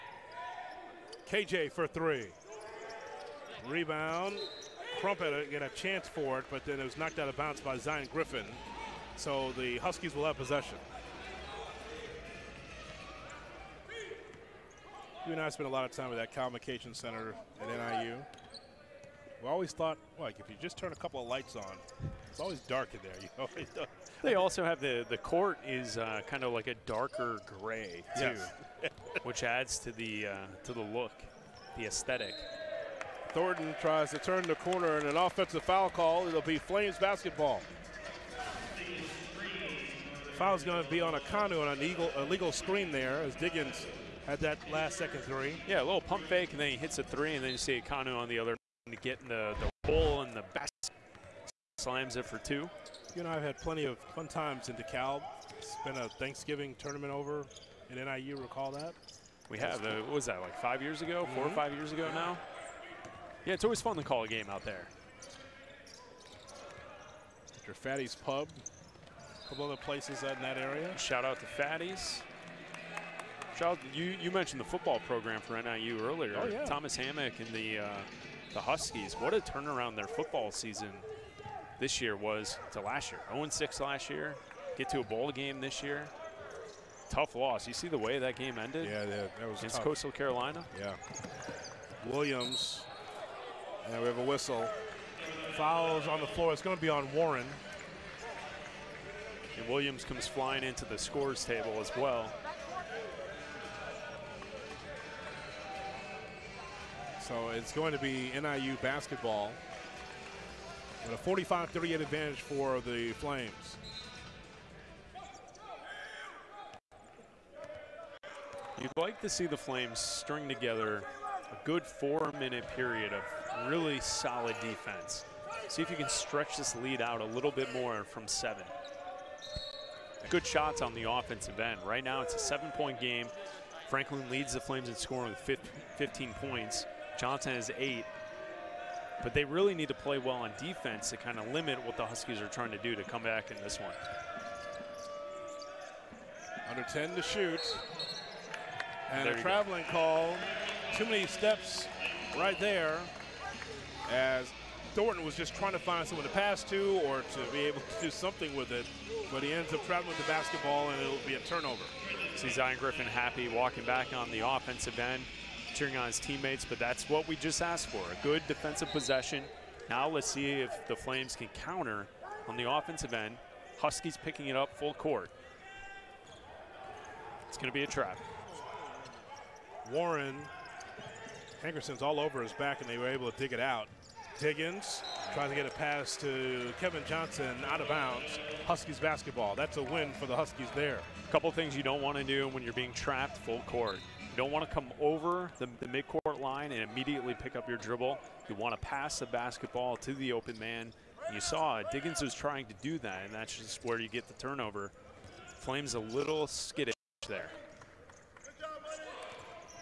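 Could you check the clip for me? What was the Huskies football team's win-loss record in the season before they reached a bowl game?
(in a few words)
0-6.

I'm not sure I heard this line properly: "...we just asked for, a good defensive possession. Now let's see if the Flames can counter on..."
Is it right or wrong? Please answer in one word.
right.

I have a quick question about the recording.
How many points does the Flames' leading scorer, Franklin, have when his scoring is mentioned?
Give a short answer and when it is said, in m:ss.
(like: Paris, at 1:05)
15, at 2:15.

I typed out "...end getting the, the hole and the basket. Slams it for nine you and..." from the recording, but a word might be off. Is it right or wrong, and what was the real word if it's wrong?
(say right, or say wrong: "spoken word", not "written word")
wrong: "two", not "nine".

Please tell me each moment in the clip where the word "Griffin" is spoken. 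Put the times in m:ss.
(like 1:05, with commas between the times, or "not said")
0:08, 2:42.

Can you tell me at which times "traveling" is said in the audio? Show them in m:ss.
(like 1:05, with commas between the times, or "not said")
2:29, 2:39.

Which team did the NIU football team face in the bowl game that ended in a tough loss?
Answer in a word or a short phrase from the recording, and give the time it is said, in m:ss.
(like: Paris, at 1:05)
Coastal Carolina, at 1:29.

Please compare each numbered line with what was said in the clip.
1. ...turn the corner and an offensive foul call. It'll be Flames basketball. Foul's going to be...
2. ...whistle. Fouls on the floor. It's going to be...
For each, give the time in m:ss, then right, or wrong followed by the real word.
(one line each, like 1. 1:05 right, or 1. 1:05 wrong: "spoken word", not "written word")
1. 0:34 right
2. 1:34 right.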